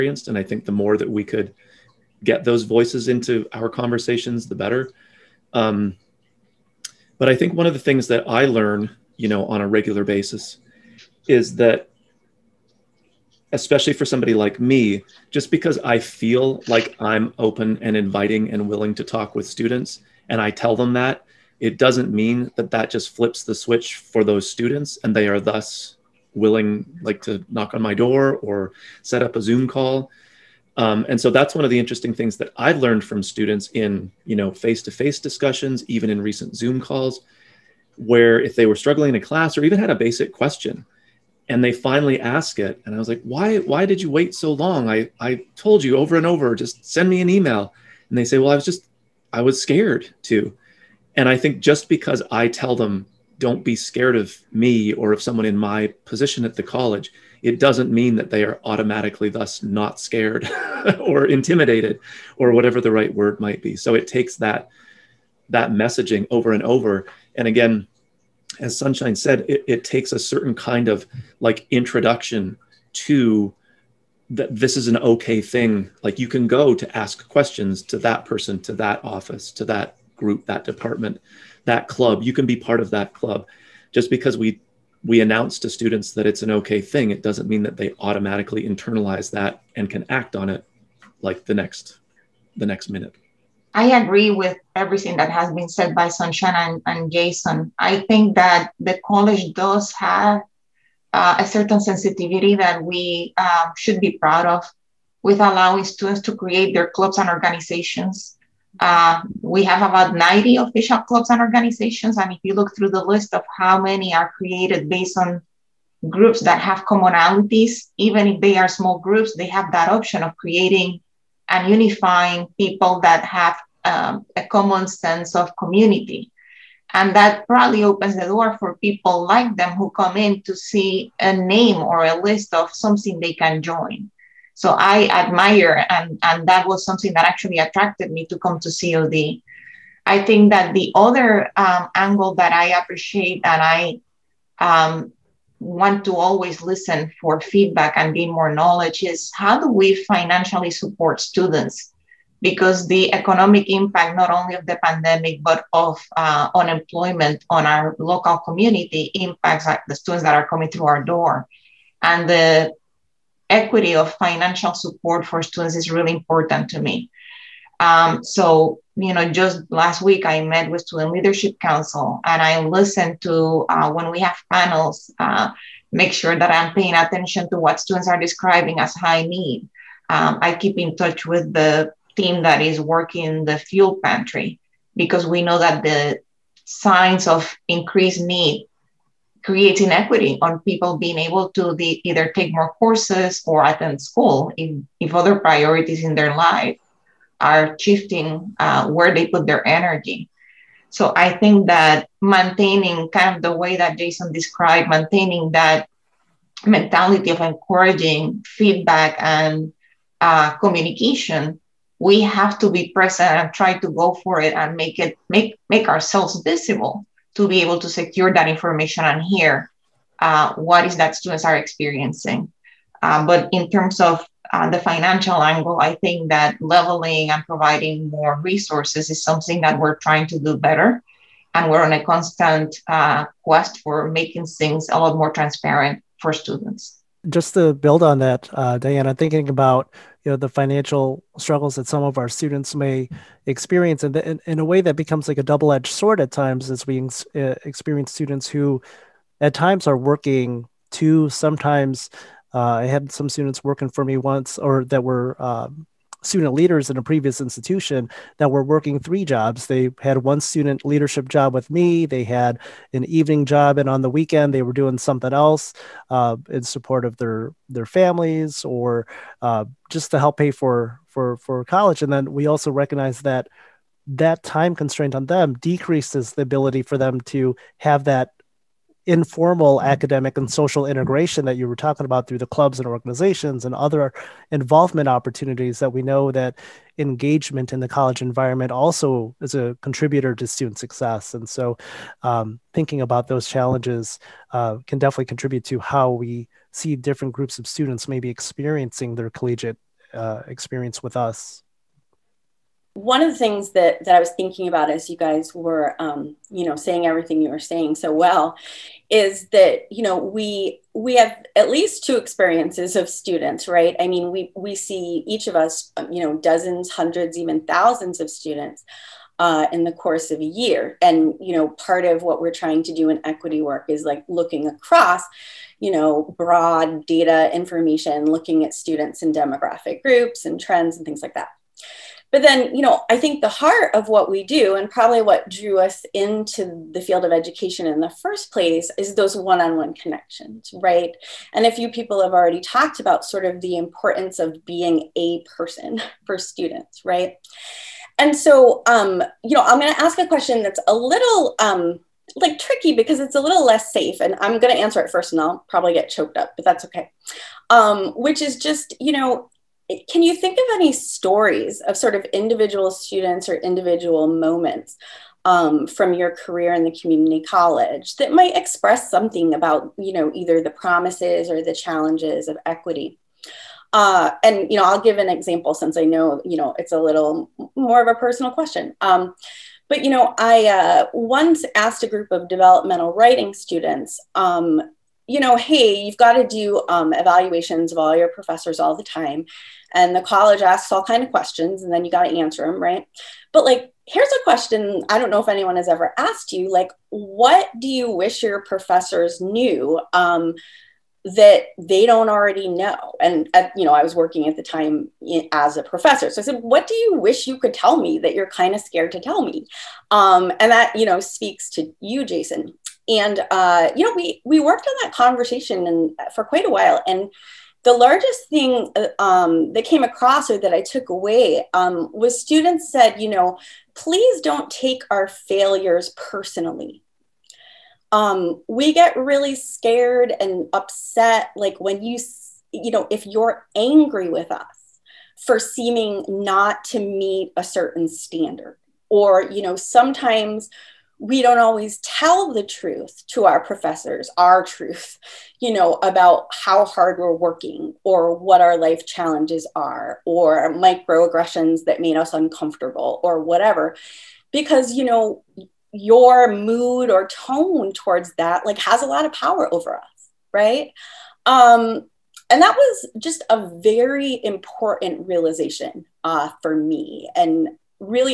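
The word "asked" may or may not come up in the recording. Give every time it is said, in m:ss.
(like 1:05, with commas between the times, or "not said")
6:21, 6:36.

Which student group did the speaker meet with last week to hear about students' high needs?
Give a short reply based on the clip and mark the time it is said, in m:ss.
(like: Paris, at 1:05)
Student Leadership Council, at 2:50.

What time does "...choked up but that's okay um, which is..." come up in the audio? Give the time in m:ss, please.
5:56.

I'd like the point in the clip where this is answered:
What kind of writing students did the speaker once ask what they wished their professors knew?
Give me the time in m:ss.
6:22.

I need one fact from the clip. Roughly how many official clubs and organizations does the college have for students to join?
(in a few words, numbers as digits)
90.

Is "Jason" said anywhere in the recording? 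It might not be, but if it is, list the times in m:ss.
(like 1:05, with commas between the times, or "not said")
1:37, 3:23, 6:52.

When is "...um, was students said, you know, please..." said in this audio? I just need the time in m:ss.
7:01.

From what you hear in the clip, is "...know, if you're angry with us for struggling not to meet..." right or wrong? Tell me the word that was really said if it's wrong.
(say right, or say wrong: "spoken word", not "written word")
wrong: "seeming", not "struggling".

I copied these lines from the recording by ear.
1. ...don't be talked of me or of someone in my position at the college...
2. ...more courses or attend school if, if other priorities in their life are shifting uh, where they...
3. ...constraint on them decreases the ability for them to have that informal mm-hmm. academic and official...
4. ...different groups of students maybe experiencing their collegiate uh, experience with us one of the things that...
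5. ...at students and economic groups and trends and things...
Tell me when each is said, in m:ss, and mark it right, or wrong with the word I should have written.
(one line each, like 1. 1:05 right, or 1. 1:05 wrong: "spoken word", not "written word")
1. 0:53 wrong: "scared", not "talked"
2. 3:12 right
3. 4:34 wrong: "social", not "official"
4. 4:56 right
5. 5:28 wrong: "demographic", not "economic".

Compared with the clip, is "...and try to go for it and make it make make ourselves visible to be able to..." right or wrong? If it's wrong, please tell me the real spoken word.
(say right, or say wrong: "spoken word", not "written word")
right.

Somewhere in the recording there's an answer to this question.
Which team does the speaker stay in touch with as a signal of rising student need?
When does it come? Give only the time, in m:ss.
3:03.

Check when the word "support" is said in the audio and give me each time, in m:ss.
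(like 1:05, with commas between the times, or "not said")
2:30, 2:44, 4:26.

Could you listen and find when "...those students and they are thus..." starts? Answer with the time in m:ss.
0:24.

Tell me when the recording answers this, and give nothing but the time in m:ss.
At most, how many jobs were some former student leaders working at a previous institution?
4:18.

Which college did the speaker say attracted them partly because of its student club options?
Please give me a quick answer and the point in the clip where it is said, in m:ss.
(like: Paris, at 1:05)
COD, at 2:18.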